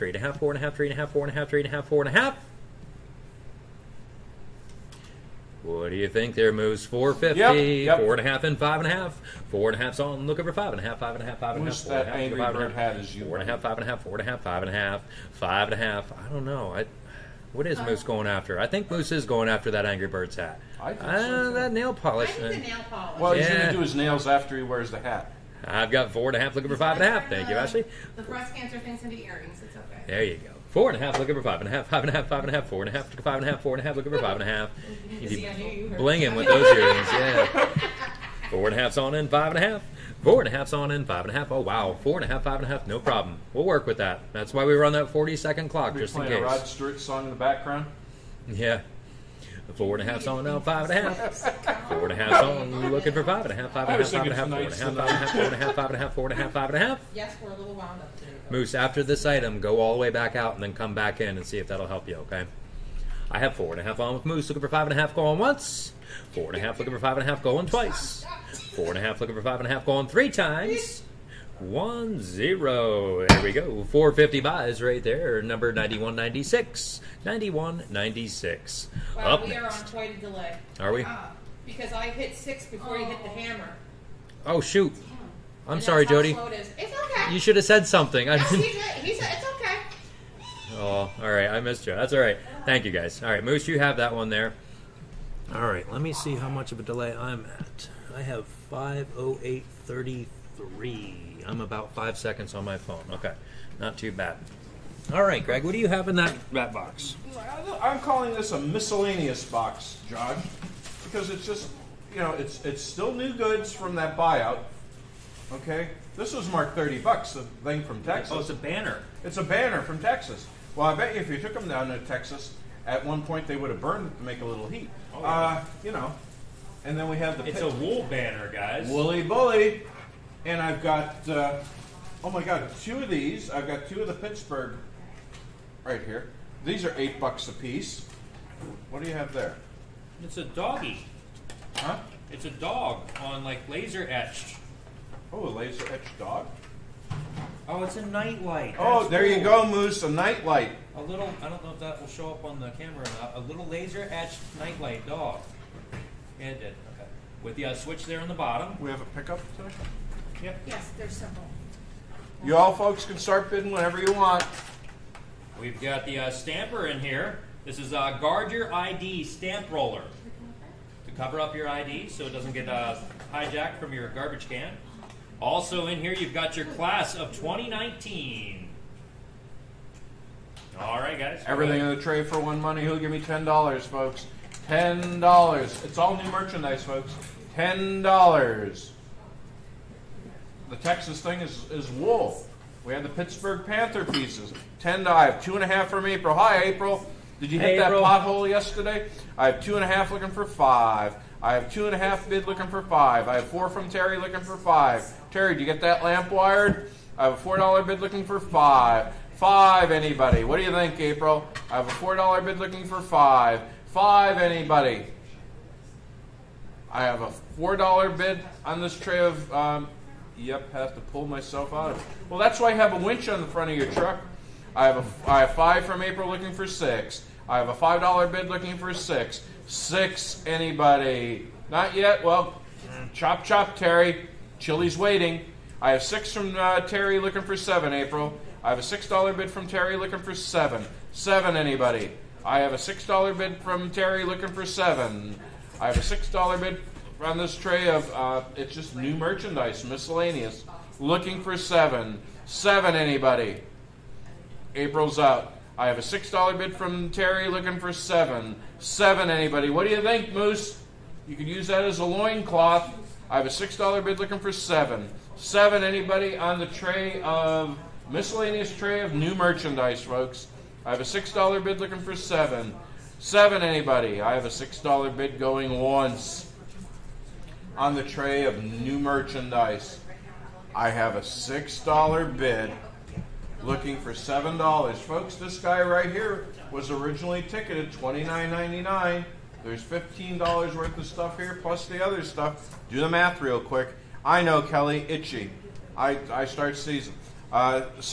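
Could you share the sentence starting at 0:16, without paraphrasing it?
I, what is uh, Moose going after?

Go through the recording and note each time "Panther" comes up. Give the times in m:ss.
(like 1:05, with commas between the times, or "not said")
3:13.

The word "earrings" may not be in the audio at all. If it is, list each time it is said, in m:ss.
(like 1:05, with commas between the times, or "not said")
0:29, 0:36.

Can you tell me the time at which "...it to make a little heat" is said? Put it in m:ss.
2:04.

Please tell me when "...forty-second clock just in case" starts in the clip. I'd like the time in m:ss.
0:45.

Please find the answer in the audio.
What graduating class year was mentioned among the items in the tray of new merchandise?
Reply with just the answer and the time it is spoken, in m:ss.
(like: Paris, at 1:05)
2019, at 2:56.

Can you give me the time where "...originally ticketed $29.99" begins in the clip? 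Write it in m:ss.
4:46.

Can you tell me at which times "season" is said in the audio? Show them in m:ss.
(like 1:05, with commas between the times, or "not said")
4:56.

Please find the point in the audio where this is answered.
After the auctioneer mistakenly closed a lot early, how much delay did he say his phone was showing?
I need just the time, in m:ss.
1:41.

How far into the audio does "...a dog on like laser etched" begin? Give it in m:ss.
2:22.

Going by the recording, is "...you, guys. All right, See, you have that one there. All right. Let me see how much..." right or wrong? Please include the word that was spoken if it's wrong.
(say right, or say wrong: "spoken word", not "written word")
wrong: "Moose", not "See".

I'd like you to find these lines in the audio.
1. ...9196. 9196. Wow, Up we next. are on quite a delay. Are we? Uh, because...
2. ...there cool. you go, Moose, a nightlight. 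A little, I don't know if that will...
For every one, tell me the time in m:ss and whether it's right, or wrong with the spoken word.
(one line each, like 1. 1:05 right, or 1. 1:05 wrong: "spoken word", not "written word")
1. 1:15 right
2. 2:29 right.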